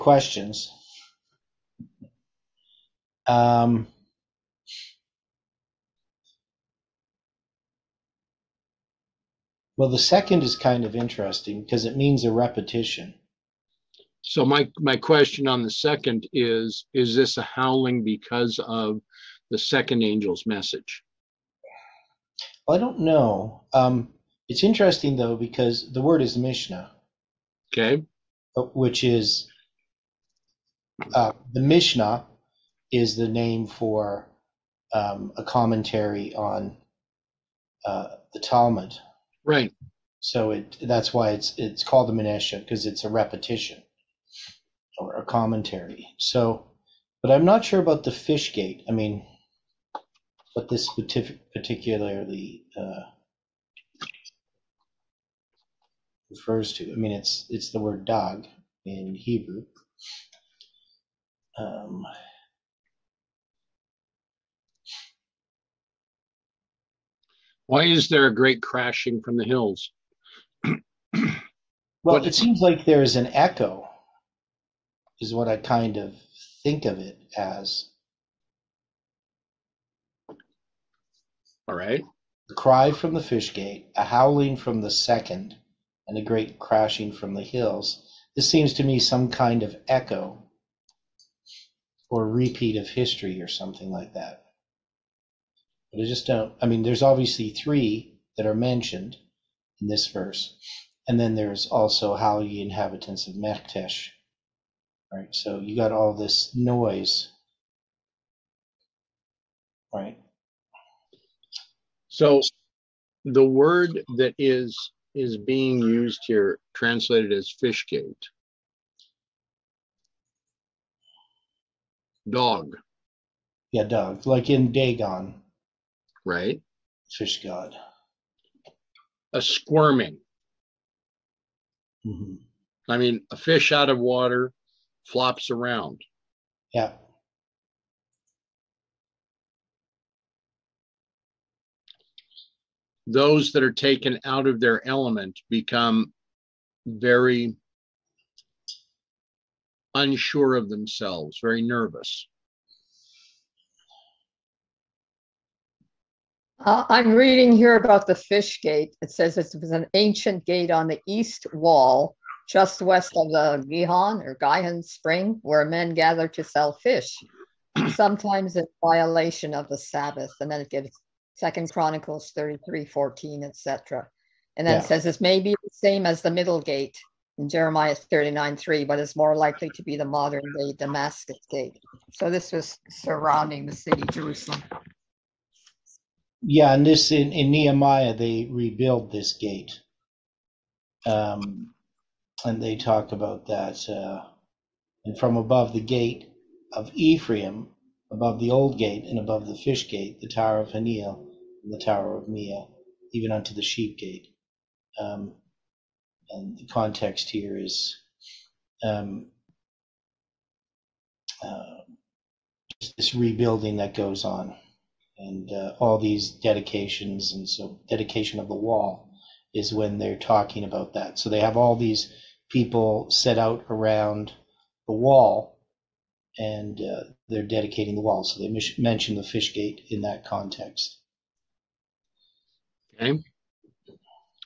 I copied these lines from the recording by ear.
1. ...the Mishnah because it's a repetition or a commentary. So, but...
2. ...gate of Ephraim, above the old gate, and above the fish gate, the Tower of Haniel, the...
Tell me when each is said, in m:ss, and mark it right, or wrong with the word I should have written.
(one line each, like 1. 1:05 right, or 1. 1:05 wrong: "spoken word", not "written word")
1. 0:42 right
2. 3:15 right.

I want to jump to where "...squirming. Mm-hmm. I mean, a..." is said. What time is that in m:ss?
2:09.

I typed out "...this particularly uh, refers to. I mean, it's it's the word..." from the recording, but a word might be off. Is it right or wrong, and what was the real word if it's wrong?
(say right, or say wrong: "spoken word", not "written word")
right.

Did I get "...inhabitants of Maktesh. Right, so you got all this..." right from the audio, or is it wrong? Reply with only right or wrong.
right.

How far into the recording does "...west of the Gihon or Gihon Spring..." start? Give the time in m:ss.
2:42.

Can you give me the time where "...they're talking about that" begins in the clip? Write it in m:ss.
3:39.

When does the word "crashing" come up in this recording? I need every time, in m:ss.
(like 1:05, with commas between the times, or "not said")
1:08, 1:26.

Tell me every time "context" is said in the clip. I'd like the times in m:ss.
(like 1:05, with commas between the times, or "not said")
3:26, 3:50.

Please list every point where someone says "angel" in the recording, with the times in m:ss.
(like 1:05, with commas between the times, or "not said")
0:20.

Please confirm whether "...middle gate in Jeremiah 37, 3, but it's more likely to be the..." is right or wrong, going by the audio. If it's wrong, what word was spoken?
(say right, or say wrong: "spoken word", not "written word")
wrong: "39", not "37".